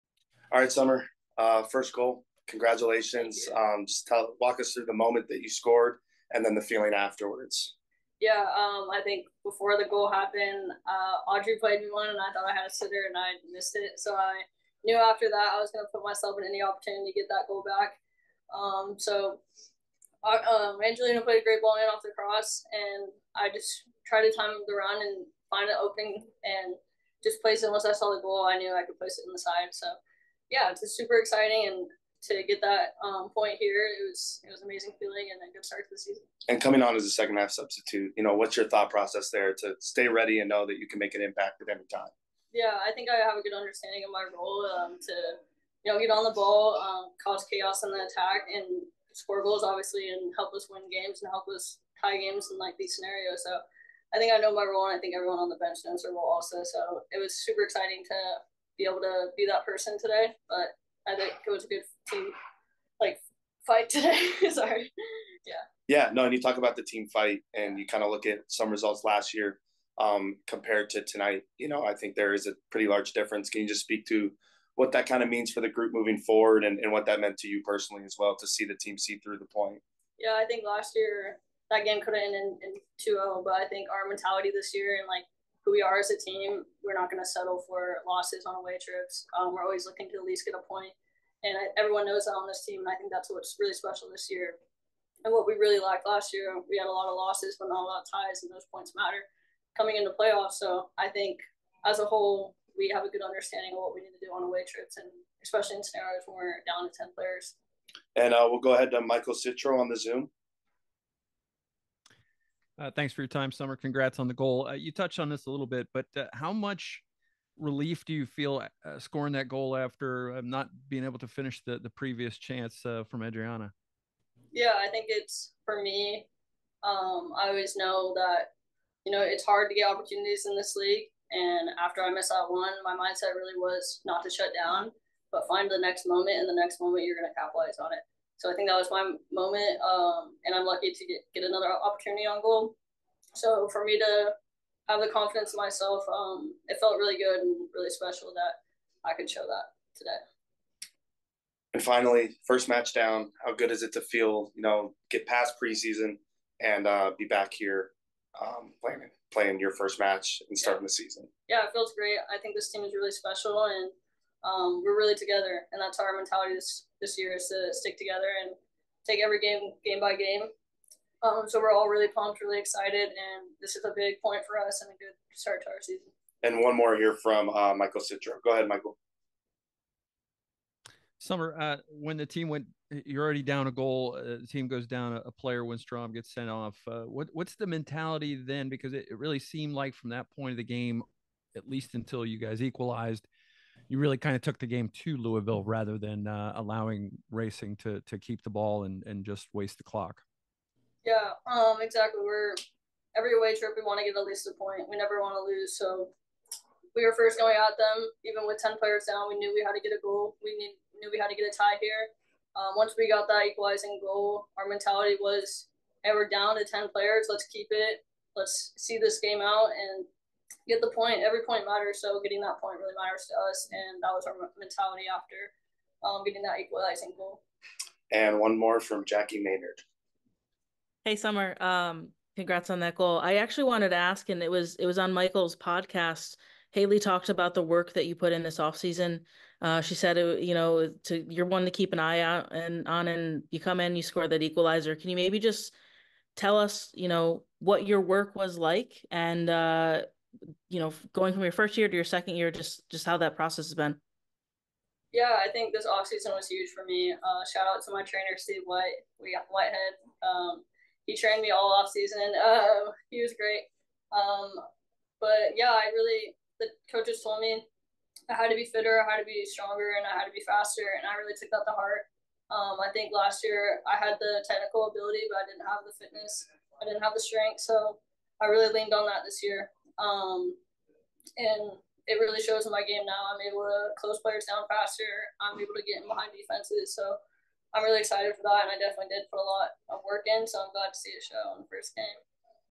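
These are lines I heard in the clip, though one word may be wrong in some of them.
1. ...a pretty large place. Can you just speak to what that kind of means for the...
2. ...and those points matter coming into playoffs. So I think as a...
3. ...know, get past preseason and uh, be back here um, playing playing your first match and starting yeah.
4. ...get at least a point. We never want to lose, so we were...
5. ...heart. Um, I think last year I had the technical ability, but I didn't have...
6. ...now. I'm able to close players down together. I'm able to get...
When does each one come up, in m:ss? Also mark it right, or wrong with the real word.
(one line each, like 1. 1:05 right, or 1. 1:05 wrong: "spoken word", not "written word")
1. 1:12 wrong: "difference", not "place"
2. 1:38 right
3. 2:34 right
4. 3:24 right
5. 4:31 right
6. 4:43 wrong: "faster", not "together".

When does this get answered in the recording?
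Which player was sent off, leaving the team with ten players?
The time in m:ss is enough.
3:05.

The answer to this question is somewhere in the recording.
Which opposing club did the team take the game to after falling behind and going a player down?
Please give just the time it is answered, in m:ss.
3:15.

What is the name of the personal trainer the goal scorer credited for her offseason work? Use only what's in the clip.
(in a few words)
Steve White.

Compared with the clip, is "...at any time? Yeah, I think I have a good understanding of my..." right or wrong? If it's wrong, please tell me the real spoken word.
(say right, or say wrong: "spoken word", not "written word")
right.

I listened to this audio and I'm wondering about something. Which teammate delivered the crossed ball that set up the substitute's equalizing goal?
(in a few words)
Angelina.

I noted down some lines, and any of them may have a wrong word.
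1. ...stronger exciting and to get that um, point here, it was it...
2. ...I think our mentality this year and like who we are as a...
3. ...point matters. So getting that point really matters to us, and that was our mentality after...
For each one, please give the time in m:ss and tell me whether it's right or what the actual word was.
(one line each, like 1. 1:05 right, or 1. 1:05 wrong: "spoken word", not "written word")
1. 0:30 wrong: "super", not "stronger"
2. 1:23 right
3. 3:41 right.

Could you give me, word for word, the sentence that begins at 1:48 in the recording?
And uh, we'll go ahead to Michael Citro on the Zoom.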